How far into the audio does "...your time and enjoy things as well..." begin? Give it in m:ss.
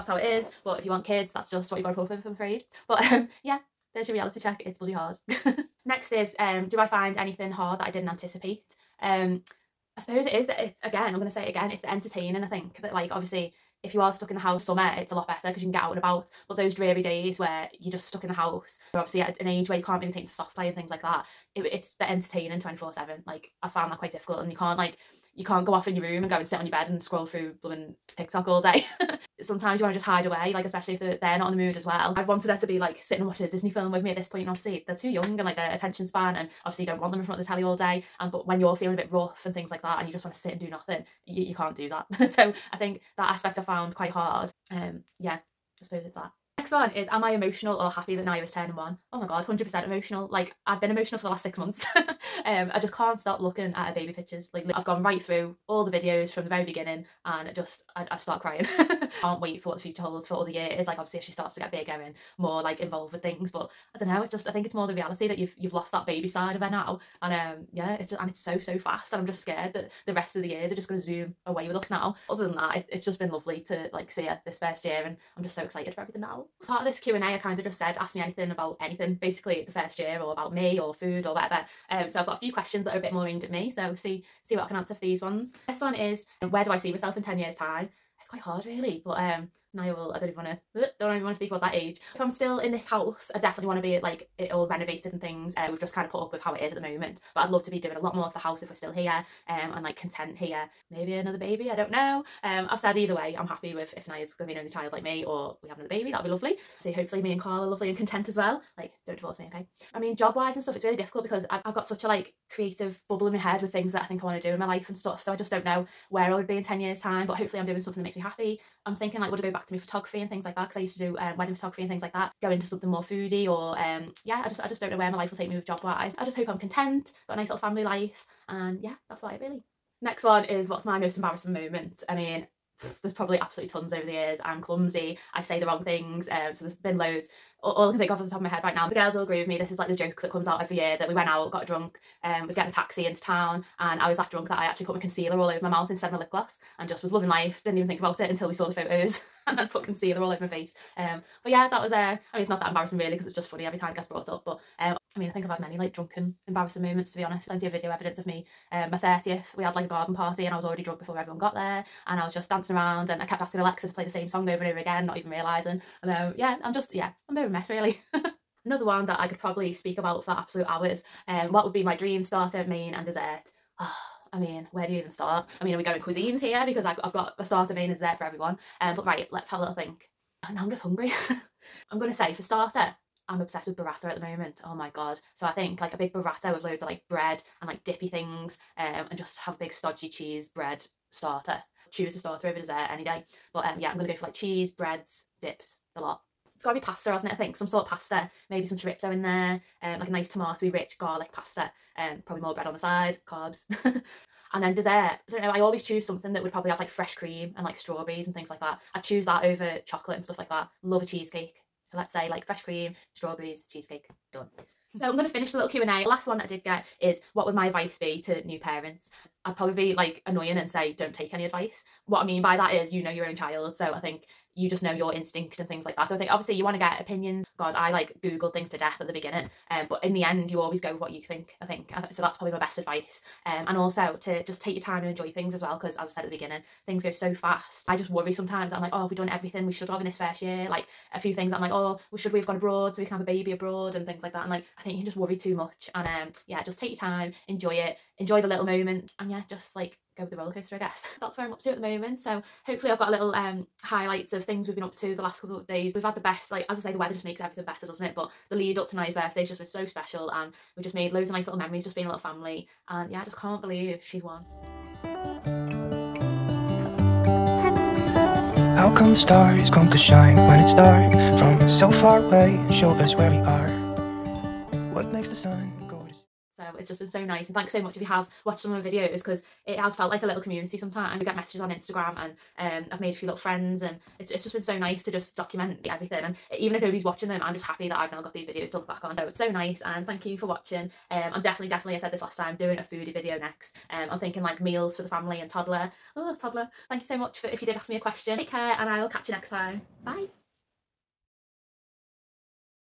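3:54.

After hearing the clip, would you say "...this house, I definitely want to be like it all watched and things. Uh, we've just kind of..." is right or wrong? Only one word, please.
wrong.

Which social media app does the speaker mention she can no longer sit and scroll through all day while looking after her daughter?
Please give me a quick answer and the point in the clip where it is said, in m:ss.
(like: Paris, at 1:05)
TikTok, at 0:28.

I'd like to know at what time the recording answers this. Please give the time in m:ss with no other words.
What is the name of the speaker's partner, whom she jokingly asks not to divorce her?
1:47.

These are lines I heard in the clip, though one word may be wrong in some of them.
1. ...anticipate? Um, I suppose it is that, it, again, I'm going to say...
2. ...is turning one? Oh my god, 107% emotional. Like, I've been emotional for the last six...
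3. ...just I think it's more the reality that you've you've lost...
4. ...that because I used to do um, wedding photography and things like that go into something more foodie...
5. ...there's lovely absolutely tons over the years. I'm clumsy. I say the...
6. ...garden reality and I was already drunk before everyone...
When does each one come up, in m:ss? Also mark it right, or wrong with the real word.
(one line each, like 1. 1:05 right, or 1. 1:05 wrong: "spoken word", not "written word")
1. 0:08 right
2. 0:48 wrong: "100", not "107"
3. 1:04 right
4. 2:00 right
5. 2:13 wrong: "probably", not "lovely"
6. 2:39 wrong: "party", not "reality".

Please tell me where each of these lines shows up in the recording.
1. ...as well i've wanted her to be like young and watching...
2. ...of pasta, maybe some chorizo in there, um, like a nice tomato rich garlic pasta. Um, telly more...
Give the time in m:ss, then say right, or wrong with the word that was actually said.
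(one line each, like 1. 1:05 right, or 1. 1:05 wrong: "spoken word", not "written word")
1. 0:31 wrong: "sitting", not "young"
2. 3:17 wrong: "probably", not "telly".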